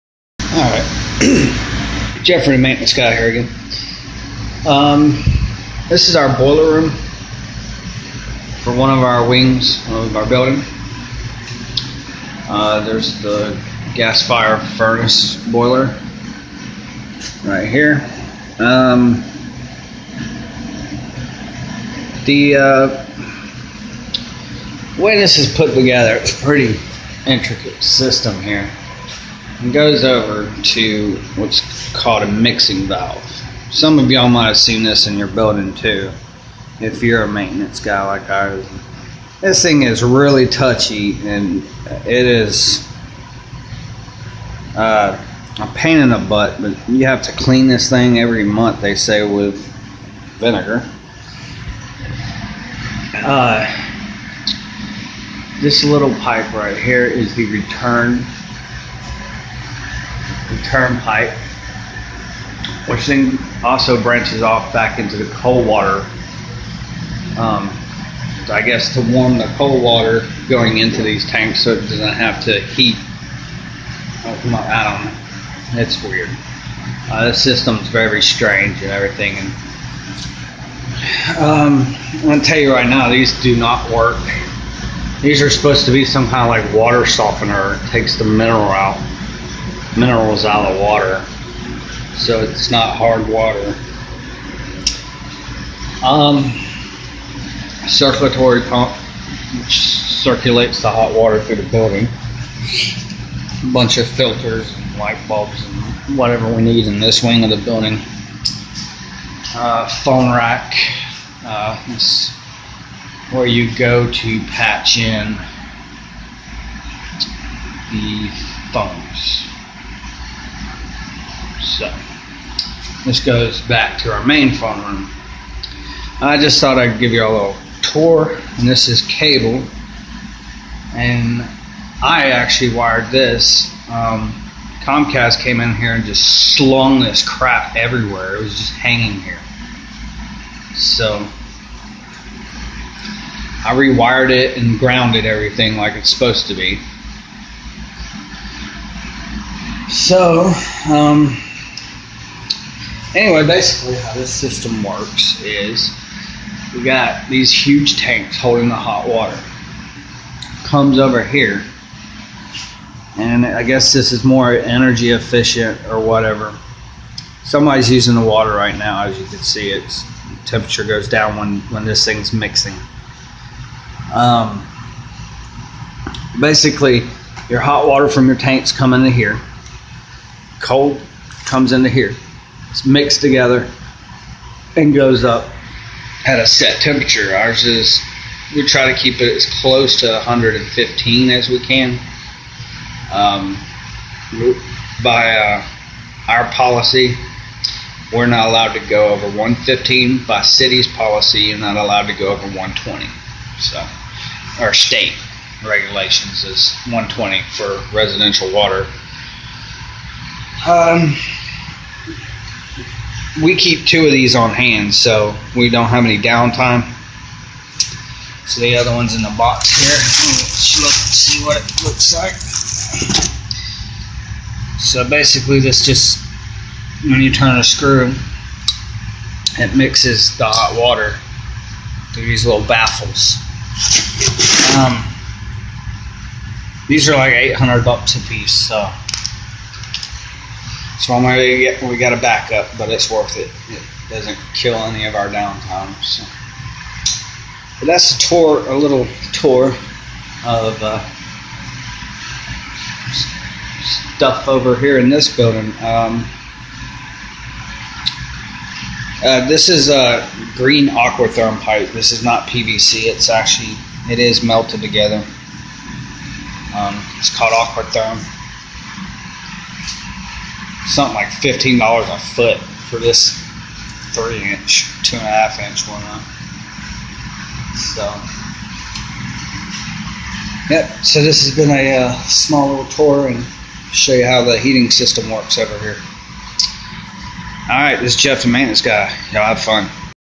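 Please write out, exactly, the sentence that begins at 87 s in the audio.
It takes the mineral out minerals out of the water.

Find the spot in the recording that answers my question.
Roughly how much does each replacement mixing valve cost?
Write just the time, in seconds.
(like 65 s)
237 s.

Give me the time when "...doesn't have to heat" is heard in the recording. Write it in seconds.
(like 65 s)
71 s.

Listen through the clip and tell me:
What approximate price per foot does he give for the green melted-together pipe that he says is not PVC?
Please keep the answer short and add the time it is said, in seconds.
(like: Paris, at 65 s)
$15, at 271 s.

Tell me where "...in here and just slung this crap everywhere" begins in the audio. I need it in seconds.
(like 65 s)
135 s.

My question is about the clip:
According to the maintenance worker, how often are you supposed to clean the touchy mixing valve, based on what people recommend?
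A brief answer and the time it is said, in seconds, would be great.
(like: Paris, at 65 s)
every month, at 48 s.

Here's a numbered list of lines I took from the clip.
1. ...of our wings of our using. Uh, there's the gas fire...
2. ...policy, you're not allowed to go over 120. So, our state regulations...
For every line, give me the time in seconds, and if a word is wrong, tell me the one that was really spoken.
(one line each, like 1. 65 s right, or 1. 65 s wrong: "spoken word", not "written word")
1. 8 s wrong: "building", not "using"
2. 200 s right.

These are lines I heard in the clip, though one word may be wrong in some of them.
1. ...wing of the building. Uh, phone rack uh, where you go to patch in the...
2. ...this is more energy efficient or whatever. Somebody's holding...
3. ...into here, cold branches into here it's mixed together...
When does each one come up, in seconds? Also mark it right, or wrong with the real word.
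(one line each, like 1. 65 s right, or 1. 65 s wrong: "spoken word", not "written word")
1. 107 s right
2. 163 s wrong: "using", not "holding"
3. 178 s wrong: "comes", not "branches".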